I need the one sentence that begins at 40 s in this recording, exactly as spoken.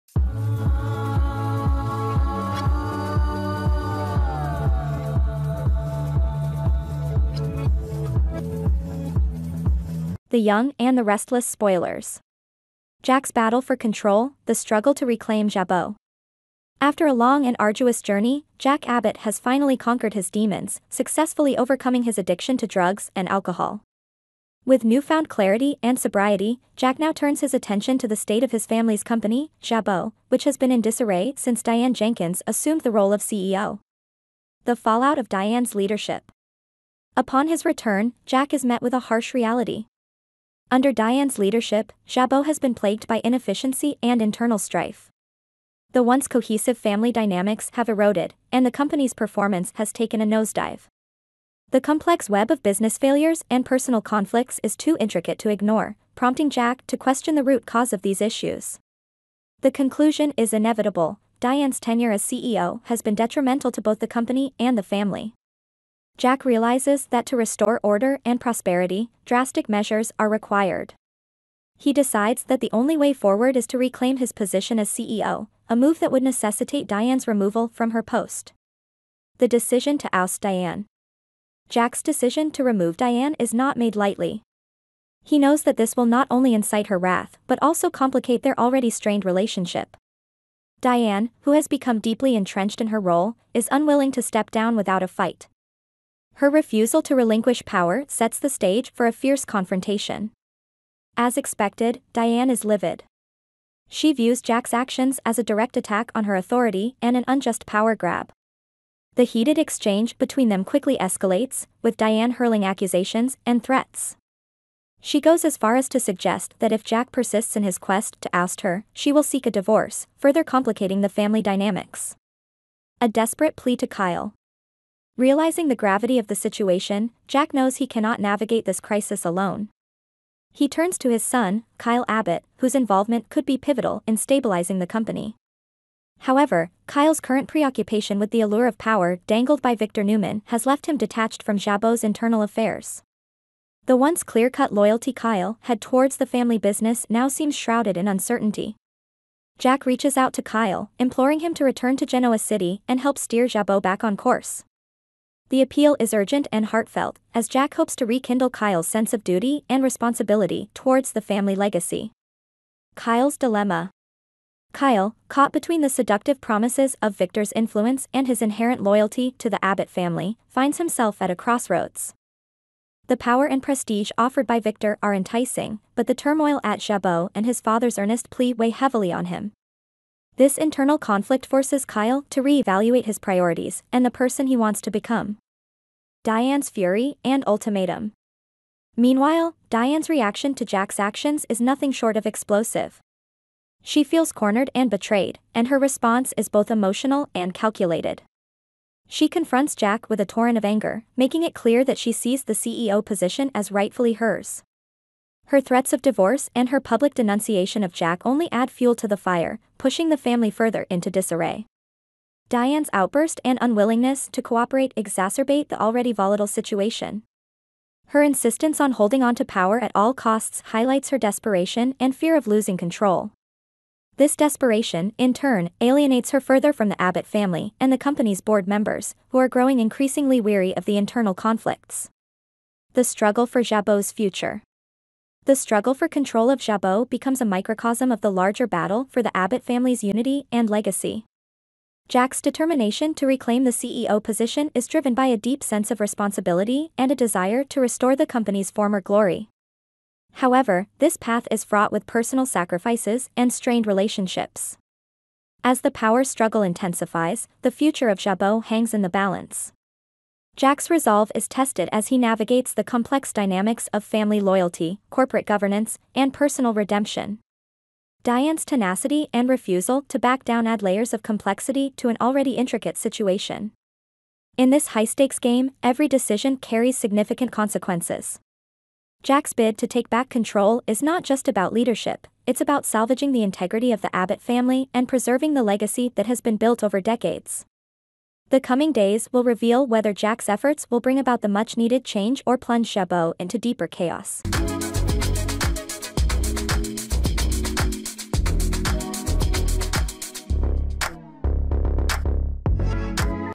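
Under Diane's leadership, Jabot has been plagued by inefficiency and internal strife.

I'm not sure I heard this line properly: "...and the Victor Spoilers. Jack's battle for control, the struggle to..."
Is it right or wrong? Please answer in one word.
wrong.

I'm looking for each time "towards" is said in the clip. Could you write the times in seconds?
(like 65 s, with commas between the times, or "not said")
145 s, 160 s.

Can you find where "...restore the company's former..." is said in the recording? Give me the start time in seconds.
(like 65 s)
247 s.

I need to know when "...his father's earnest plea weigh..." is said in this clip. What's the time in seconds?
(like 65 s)
177 s.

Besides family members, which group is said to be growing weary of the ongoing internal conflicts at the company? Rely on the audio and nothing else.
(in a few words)
board members.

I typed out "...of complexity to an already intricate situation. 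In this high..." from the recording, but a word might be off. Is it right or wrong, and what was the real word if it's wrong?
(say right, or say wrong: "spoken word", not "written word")
right.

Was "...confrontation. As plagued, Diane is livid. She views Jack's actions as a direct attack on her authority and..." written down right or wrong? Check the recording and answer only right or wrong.
wrong.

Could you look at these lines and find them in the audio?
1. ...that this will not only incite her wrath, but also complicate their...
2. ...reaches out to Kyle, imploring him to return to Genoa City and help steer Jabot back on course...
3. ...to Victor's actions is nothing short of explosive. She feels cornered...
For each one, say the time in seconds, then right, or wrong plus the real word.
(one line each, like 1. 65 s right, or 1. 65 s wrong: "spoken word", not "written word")
1. 85 s right
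2. 149 s right
3. 190 s wrong: "Jack", not "Victor".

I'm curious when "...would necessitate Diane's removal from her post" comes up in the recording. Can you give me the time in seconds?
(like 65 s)
76 s.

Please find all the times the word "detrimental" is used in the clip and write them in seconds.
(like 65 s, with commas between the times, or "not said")
63 s.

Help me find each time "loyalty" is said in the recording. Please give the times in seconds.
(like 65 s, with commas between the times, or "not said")
144 s, 168 s, 264 s.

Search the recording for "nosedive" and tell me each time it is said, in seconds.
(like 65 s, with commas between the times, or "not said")
50 s.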